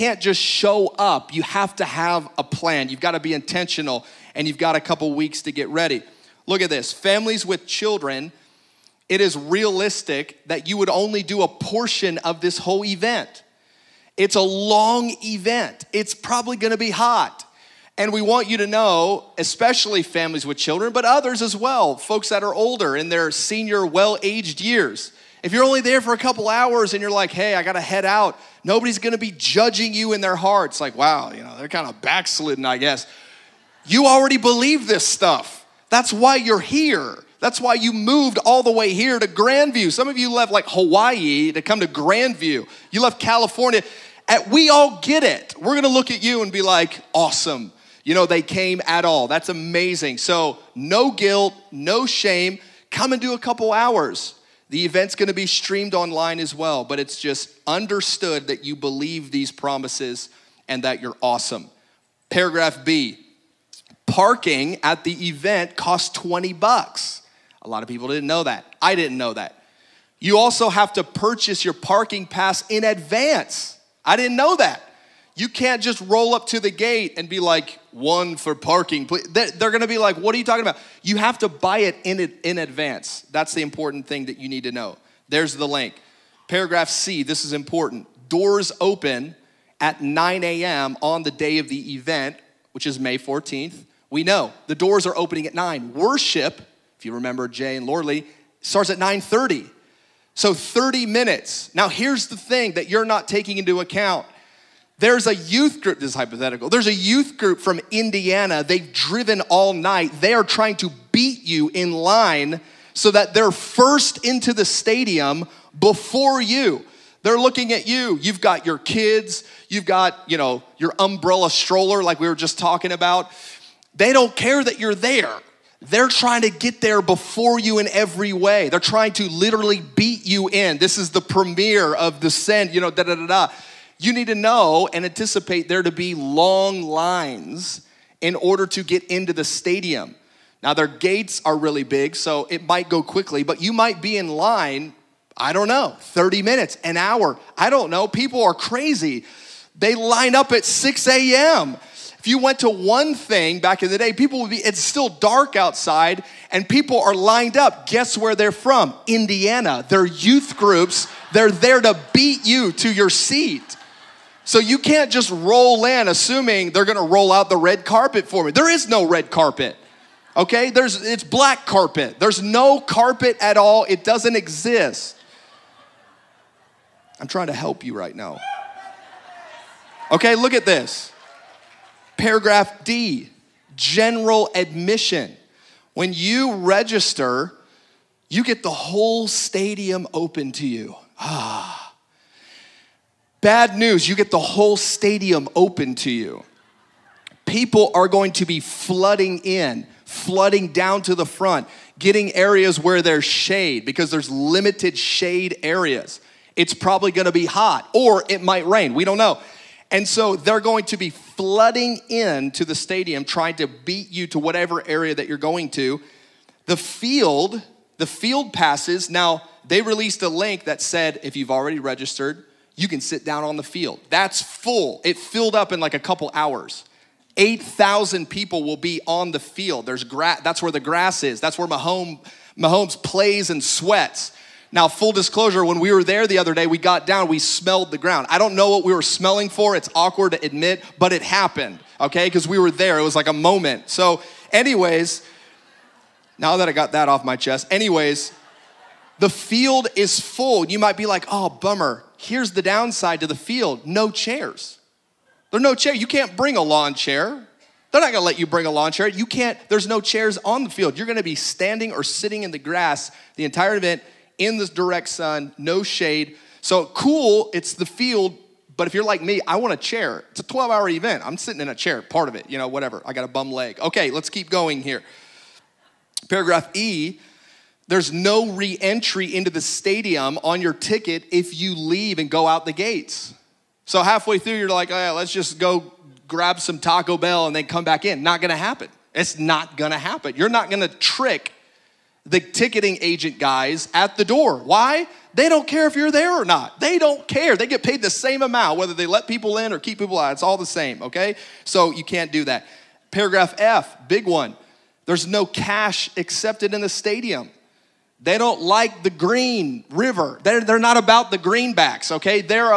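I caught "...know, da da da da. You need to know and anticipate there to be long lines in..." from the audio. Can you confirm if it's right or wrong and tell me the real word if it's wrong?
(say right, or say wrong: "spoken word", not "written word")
right.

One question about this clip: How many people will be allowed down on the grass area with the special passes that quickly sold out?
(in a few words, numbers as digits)
8,000.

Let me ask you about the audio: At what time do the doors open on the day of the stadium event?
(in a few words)
9 a.m.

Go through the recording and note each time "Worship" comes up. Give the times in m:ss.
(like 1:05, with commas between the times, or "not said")
1:35.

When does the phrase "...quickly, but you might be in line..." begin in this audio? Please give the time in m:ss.
2:23.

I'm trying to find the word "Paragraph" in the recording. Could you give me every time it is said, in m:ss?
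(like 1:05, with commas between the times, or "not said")
1:02, 1:26, 3:02, 4:36, 5:03.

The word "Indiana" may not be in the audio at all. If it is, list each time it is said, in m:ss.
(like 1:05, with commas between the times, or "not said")
1:47, 2:39.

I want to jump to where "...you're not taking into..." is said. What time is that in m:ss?
1:42.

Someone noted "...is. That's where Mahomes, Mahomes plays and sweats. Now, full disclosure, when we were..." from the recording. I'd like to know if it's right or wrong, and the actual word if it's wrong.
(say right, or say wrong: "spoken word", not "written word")
right.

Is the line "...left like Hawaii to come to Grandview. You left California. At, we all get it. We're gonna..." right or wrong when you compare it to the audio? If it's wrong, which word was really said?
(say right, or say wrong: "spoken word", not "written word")
right.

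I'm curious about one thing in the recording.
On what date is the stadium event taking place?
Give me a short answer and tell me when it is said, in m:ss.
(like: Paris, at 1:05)
May 14th, at 1:32.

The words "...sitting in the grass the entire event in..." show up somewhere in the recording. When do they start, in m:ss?
4:22.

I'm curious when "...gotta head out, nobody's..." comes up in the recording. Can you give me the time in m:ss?
0:27.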